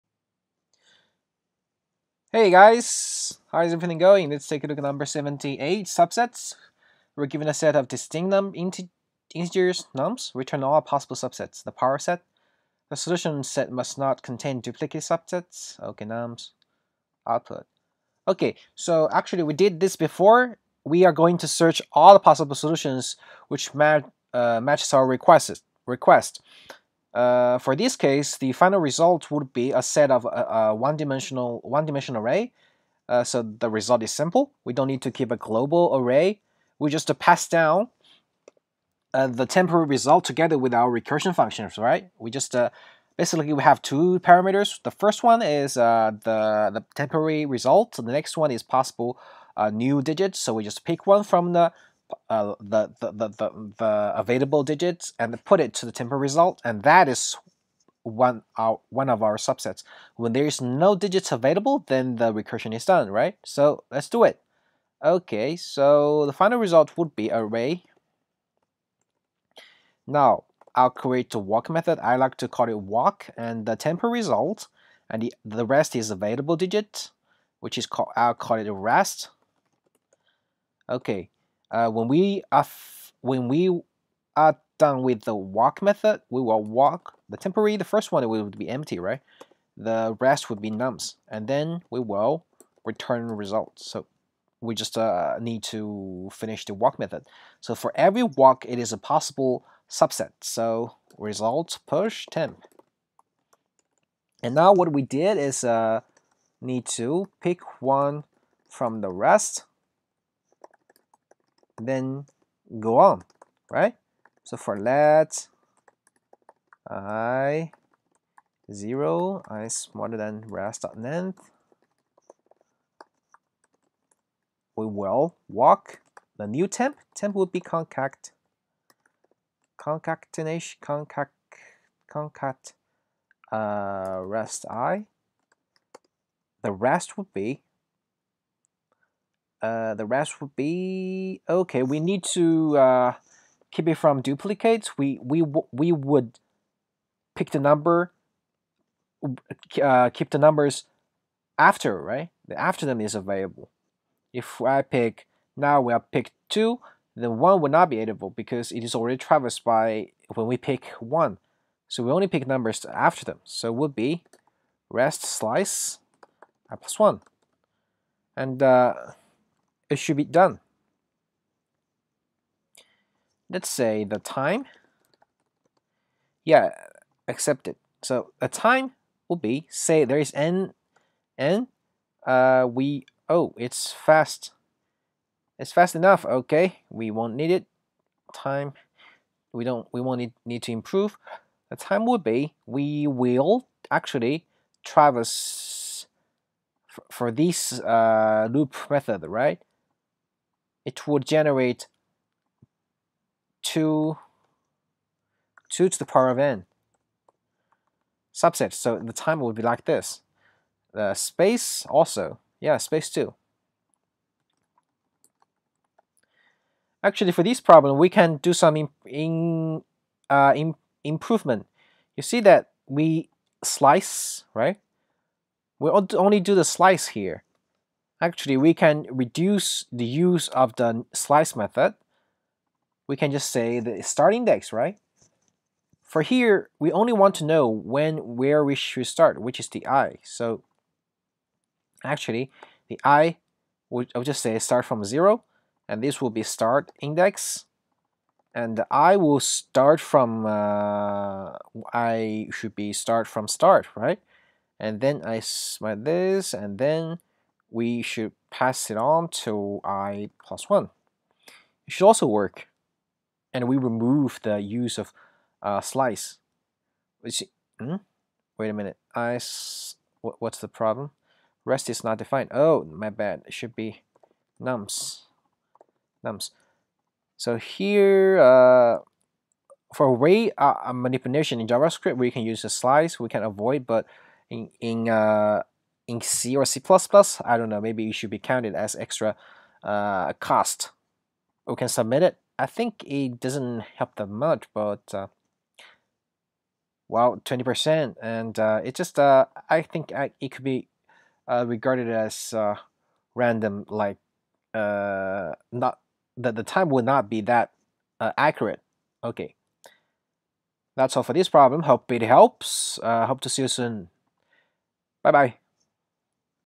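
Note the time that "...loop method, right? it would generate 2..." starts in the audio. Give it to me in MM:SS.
03:18.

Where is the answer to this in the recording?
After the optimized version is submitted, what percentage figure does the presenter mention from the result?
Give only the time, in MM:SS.
04:57.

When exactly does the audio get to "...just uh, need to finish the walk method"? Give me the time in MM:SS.
01:34.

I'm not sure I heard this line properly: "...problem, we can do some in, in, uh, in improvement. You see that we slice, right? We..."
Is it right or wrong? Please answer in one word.
right.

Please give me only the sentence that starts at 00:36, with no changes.
We just pass down uh, the temporary result together with our recursion functions, right?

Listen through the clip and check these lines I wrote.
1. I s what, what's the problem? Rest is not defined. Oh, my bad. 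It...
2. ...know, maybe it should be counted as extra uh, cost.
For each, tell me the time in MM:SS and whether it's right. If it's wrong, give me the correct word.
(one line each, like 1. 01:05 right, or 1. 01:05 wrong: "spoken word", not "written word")
1. 04:29 right
2. 04:47 right.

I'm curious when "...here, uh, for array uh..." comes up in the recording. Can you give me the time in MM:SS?
04:37.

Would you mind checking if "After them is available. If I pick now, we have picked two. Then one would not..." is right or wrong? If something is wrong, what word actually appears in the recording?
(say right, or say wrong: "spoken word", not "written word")
right.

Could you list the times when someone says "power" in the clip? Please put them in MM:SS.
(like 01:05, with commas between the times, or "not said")
00:11, 03:26.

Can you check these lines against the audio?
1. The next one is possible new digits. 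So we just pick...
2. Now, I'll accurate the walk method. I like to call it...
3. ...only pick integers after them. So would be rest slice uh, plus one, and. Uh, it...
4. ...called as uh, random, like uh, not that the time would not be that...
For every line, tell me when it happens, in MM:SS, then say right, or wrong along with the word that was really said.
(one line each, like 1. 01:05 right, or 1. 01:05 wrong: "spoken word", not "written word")
1. 00:47 right
2. 01:10 wrong: "create", not "accurate"
3. 02:42 wrong: "numbers", not "integers"
4. 05:01 wrong: "regarded", not "called".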